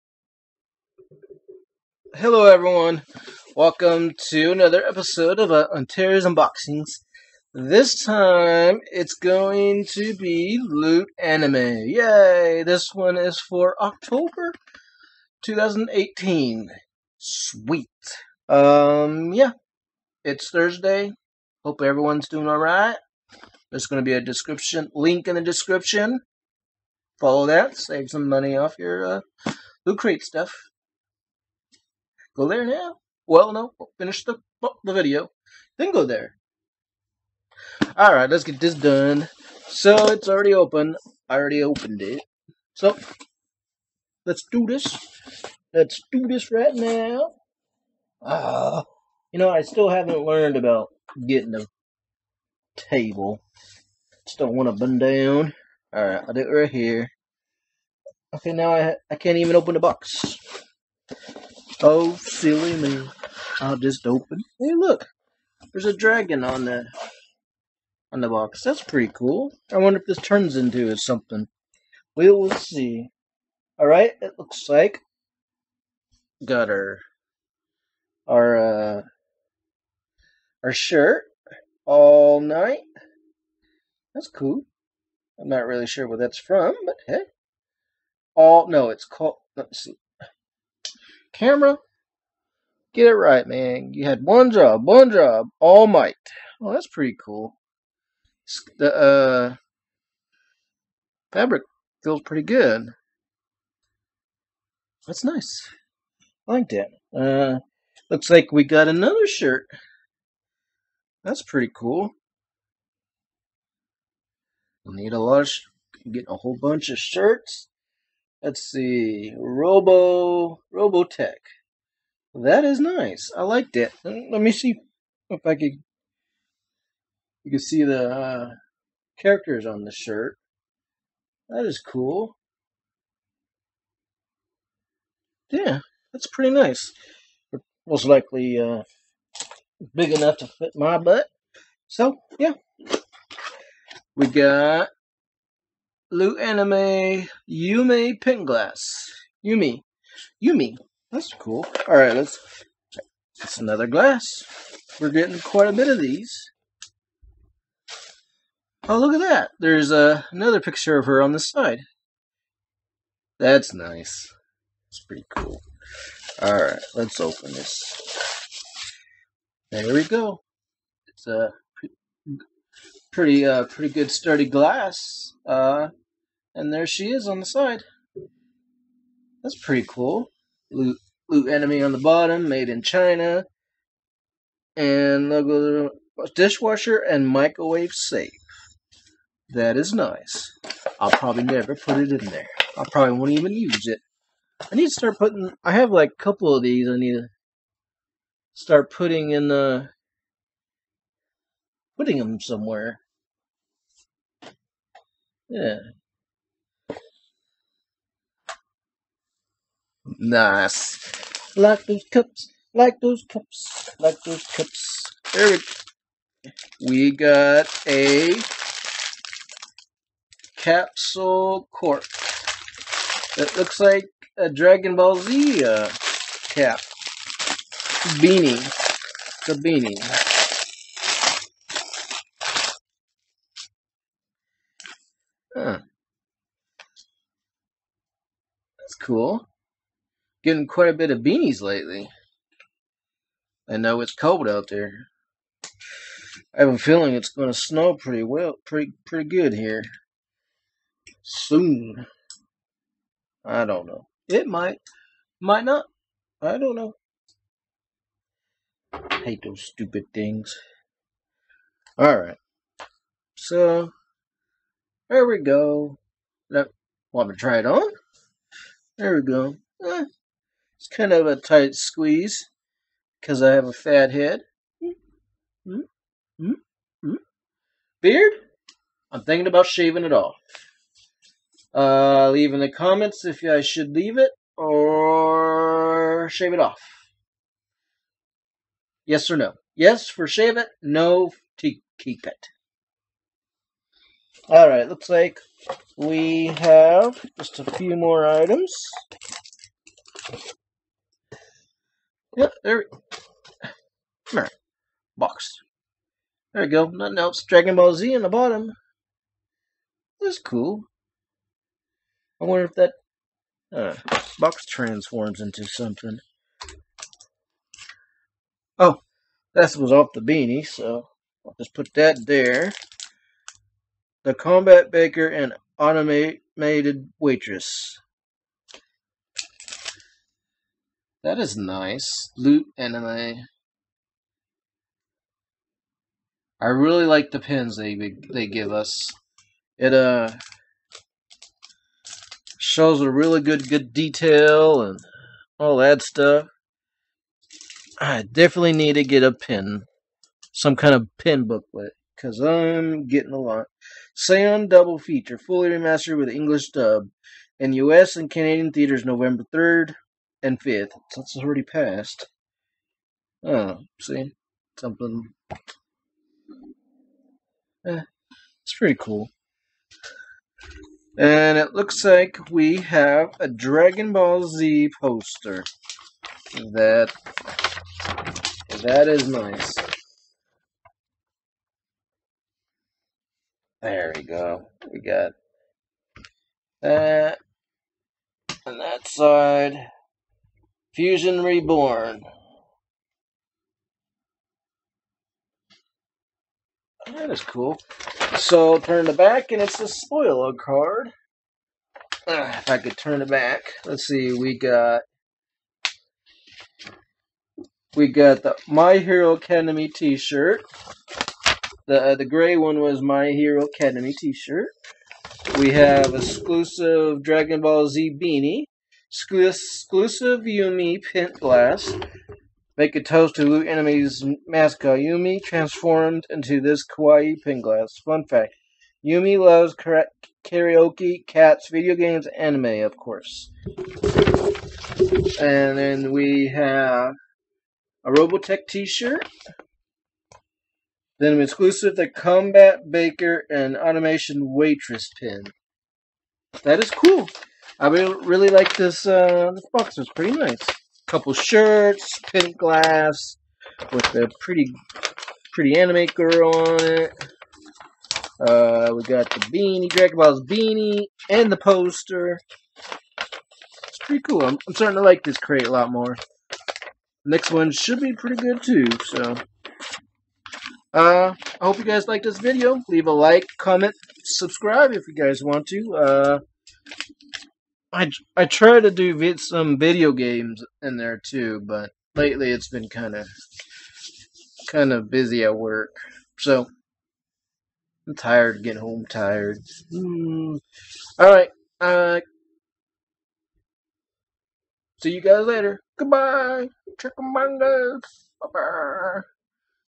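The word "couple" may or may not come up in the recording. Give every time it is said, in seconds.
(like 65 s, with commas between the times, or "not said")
196 s, 451 s.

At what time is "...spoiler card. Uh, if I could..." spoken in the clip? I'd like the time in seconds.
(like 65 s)
399 s.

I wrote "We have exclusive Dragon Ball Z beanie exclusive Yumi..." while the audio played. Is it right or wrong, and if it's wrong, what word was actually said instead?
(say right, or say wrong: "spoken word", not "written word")
right.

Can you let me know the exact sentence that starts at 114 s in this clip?
We'll need a lot of, get a whole bunch of shirts.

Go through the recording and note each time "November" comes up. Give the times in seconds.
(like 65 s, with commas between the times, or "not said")
359 s.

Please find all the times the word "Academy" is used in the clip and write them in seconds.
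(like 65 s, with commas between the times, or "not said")
409 s, 413 s.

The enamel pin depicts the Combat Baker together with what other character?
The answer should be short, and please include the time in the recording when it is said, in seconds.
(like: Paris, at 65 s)
Automated Waitress, at 325 s.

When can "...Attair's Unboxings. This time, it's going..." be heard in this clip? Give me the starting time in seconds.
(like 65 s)
5 s.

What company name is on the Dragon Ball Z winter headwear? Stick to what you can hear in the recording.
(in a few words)
Capsule Corp.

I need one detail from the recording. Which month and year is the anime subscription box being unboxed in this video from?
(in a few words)
October 2018.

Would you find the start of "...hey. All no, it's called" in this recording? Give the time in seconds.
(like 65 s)
87 s.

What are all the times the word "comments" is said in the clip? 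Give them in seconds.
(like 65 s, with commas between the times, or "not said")
282 s, 473 s.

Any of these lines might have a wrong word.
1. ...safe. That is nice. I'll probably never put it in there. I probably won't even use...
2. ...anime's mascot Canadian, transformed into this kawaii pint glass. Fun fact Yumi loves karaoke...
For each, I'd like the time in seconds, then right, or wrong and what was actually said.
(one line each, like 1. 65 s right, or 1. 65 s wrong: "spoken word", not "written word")
1. 187 s right
2. 423 s wrong: "Yumi", not "Canadian".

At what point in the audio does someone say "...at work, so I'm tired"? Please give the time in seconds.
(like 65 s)
485 s.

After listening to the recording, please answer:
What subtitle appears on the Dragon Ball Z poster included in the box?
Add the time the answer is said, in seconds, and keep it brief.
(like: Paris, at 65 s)
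Fusion Reborn, at 390 s.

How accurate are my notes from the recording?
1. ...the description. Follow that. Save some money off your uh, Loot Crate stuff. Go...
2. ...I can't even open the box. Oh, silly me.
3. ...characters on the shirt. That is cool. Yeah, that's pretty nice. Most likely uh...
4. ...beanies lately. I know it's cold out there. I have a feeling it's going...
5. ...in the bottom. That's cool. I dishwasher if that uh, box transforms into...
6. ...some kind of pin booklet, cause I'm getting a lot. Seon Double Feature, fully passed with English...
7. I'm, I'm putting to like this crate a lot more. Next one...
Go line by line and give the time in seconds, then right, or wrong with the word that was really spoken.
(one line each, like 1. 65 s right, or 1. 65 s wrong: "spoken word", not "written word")
1. 25 s right
2. 59 s right
3. 129 s right
4. 241 s right
5. 308 s wrong: "wonder", not "dishwasher"
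6. 350 s wrong: "remastered", not "passed"
7. 464 s wrong: "starting", not "putting".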